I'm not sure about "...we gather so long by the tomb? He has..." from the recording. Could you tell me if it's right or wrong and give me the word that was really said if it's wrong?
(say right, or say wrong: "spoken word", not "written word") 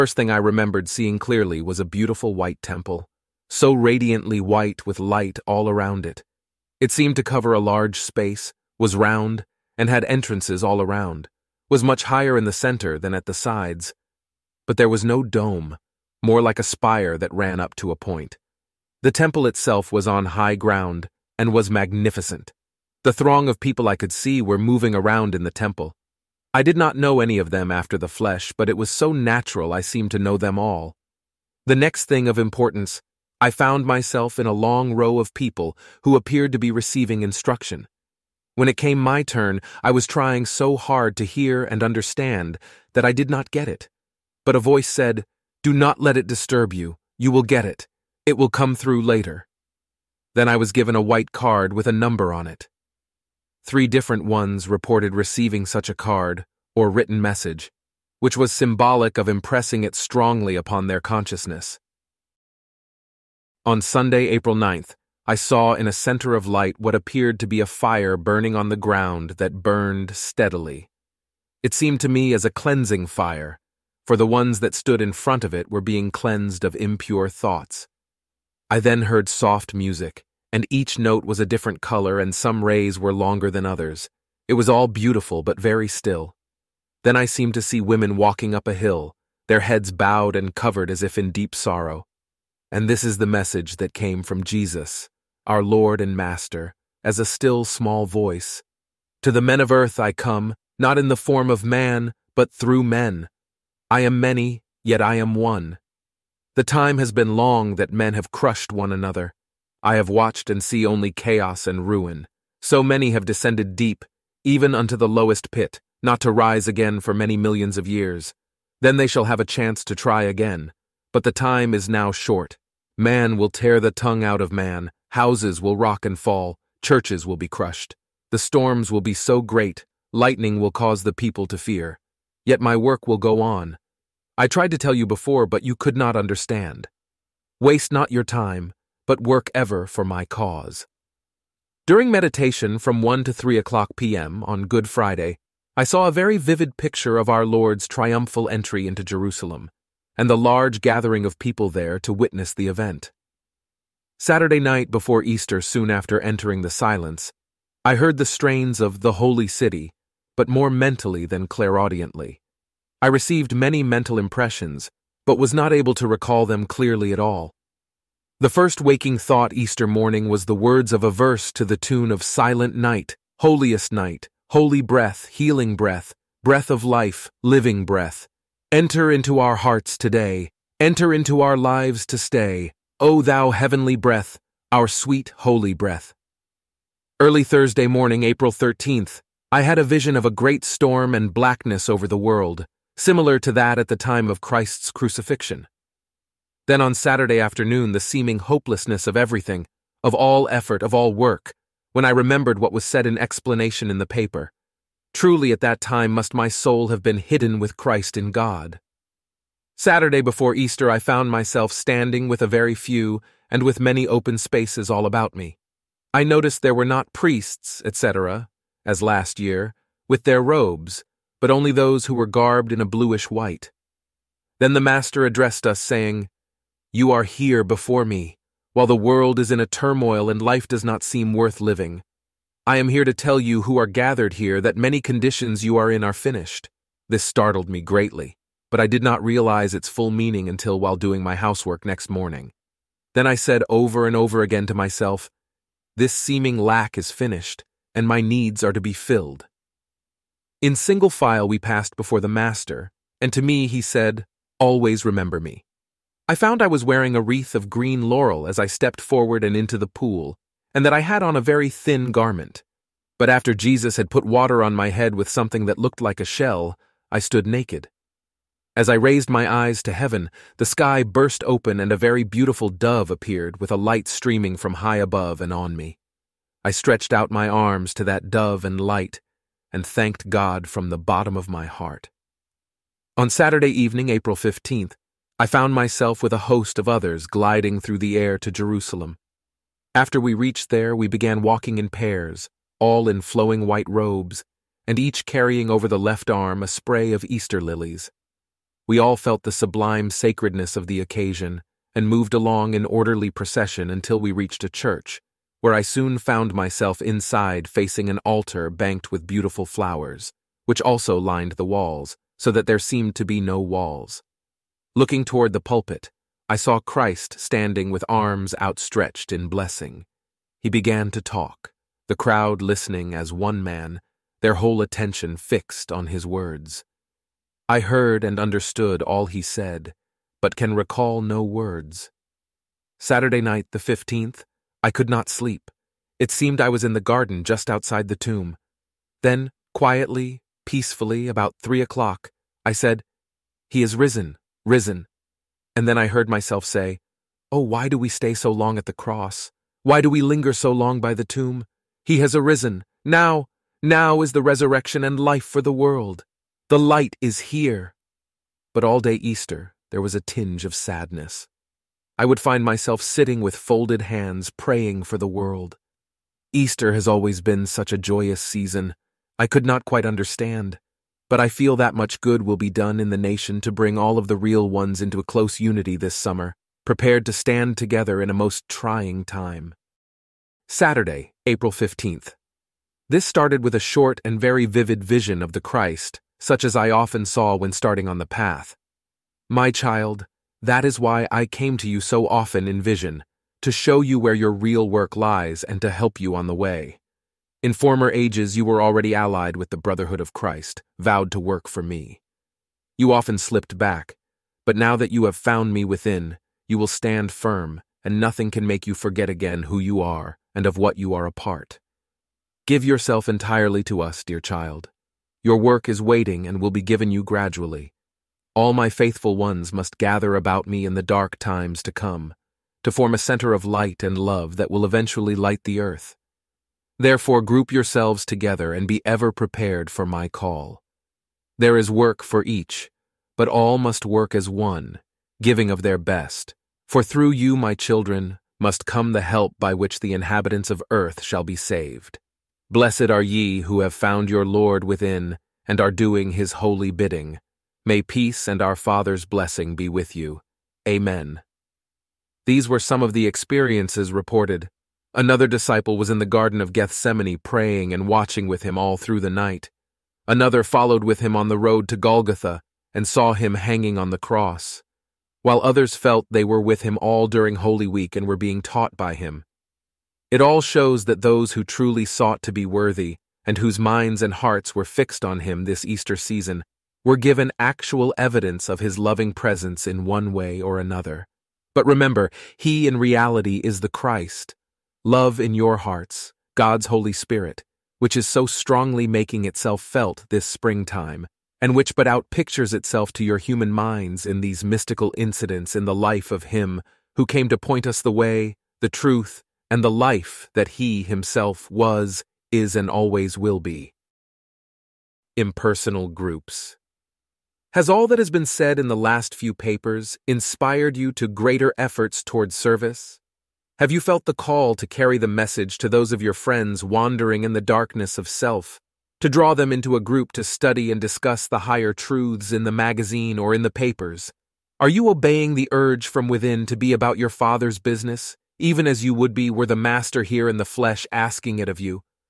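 wrong: "linger", not "gather".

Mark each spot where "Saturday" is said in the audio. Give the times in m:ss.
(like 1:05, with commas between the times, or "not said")
2:34, 3:16, 3:29, 4:43, 5:32, 6:20.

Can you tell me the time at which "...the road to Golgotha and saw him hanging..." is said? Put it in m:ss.
7:41.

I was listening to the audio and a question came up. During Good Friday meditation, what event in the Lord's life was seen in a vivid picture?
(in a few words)
Triumphal entry into Jerusalem.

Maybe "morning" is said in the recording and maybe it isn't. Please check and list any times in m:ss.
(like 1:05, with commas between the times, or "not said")
2:49, 3:07, 4:02.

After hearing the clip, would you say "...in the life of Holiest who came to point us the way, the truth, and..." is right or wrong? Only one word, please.
wrong.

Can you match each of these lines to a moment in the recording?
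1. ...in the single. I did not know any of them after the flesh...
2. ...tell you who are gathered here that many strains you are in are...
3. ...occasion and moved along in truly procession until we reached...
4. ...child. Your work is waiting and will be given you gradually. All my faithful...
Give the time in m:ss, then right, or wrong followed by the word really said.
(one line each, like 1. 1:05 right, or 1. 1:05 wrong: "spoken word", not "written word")
1. 0:25 wrong: "temple", not "single"
2. 3:53 wrong: "conditions", not "strains"
3. 5:00 wrong: "orderly", not "truly"
4. 6:54 right.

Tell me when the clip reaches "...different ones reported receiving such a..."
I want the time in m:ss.
0:53.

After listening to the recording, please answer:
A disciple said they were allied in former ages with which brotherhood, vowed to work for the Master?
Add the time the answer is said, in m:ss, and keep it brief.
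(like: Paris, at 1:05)
Brotherhood of Christ, at 6:39.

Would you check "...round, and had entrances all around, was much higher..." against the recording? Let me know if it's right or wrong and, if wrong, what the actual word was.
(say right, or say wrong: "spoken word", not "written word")
right.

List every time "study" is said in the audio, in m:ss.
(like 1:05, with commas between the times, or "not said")
8:40.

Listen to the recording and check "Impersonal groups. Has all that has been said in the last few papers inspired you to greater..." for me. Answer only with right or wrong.
right.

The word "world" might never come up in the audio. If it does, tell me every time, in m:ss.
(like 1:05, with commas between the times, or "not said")
3:12, 3:48, 5:55, 6:05.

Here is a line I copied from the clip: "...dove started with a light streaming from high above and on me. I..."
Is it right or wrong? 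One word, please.
wrong.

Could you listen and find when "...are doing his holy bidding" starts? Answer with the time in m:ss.
7:25.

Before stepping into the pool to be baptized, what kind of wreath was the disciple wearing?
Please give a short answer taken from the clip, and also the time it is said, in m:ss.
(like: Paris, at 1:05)
Green laurel, at 4:17.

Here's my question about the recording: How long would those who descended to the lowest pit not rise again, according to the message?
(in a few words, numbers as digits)
Many millions of years.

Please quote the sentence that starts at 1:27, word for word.
Then I seemed to see women walking up a hill, their heads bowed and covered as if in deep sorrow.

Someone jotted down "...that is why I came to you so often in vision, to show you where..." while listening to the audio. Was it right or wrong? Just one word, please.
right.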